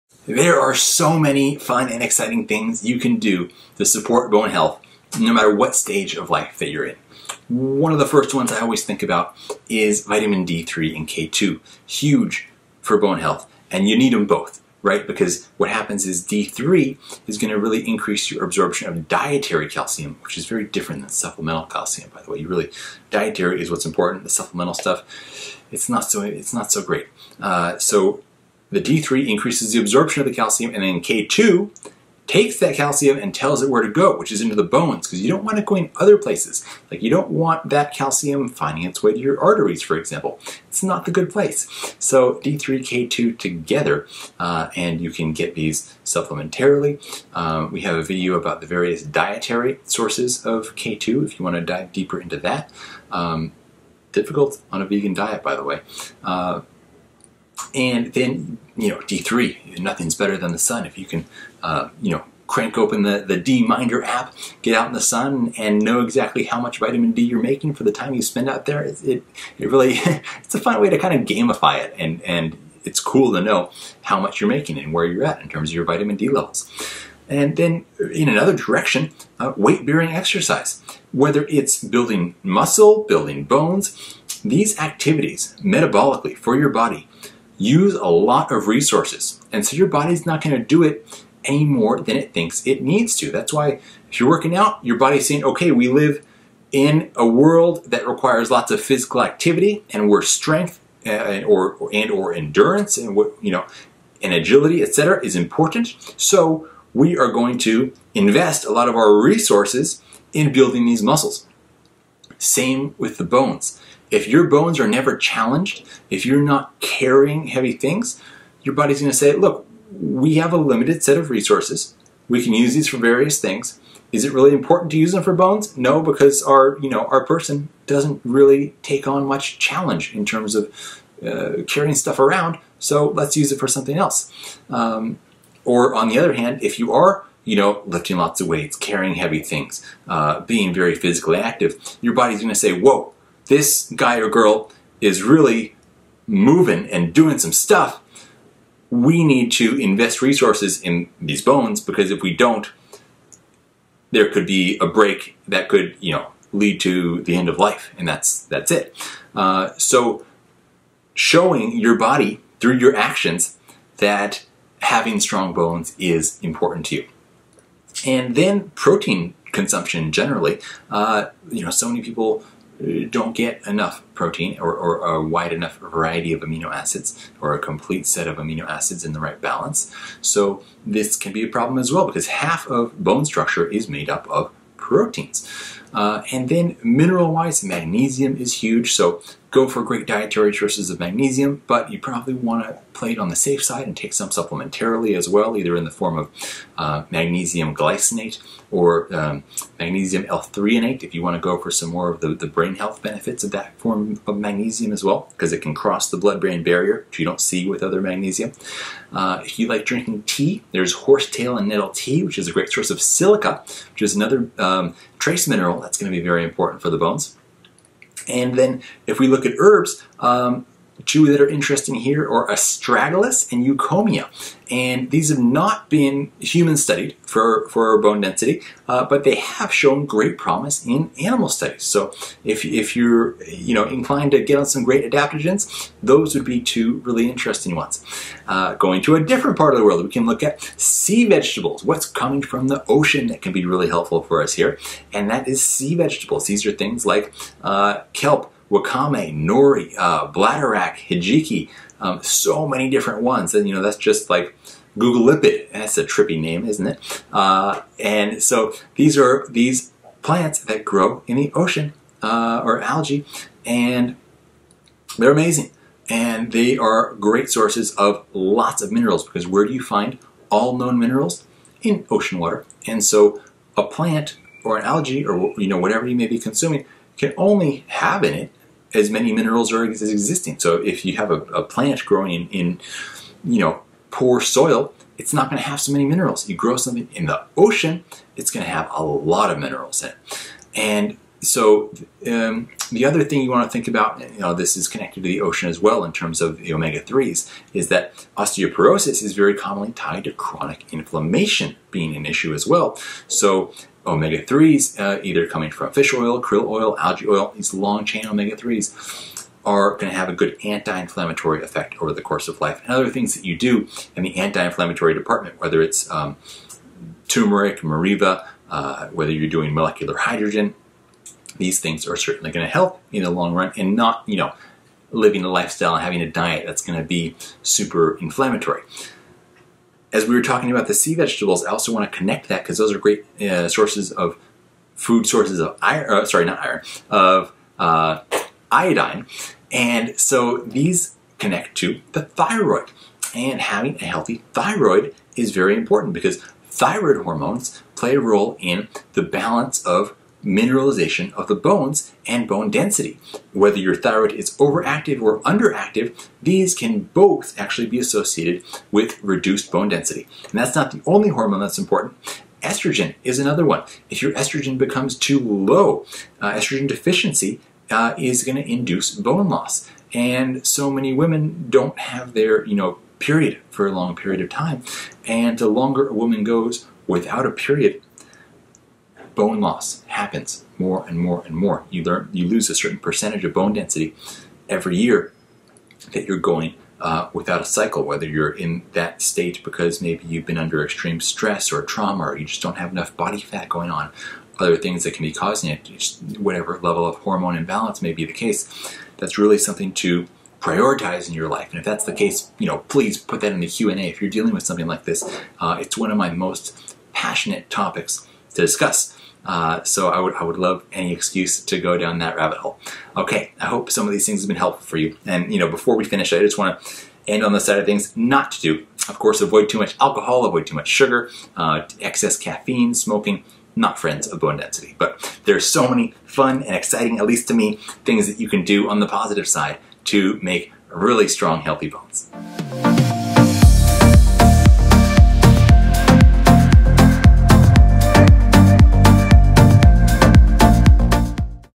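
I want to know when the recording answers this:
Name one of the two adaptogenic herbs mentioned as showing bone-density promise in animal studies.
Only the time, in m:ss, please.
3:42.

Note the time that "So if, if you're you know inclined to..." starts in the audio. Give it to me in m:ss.
3:51.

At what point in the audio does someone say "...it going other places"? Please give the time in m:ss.
0:35.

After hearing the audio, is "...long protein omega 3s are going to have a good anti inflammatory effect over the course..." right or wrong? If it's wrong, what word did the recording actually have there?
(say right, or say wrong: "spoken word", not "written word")
wrong: "chain", not "protein".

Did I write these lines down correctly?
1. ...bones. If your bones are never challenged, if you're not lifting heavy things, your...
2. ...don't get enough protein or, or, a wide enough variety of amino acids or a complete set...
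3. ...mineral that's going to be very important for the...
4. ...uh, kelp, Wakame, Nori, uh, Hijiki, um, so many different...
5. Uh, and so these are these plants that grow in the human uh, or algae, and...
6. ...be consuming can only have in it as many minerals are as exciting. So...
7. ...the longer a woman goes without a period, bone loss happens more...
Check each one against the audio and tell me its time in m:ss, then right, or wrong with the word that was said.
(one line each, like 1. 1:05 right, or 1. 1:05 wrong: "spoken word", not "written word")
1. 1:53 wrong: "carrying", not "lifting"
2. 2:53 right
3. 3:35 right
4. 4:07 right
5. 4:17 wrong: "ocean", not "human"
6. 4:36 wrong: "existing", not "exciting"
7. 6:15 right.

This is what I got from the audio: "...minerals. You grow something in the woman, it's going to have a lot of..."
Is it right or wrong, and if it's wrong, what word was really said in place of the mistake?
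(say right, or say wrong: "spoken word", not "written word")
wrong: "ocean", not "woman".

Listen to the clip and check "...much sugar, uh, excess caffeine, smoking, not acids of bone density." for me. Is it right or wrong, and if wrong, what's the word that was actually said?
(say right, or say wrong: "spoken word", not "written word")
wrong: "friends", not "acids".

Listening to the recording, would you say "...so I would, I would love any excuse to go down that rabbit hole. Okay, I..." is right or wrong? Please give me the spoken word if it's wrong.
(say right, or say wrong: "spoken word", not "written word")
right.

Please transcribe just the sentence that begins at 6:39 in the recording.
That's really something to prioritize in your life.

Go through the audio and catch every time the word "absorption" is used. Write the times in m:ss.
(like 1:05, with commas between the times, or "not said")
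0:18, 0:29.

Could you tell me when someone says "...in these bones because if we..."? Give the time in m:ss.
2:30.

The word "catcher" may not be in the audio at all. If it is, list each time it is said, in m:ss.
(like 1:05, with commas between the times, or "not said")
not said.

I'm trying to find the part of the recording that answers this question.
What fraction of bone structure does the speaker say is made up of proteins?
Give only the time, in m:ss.
3:02.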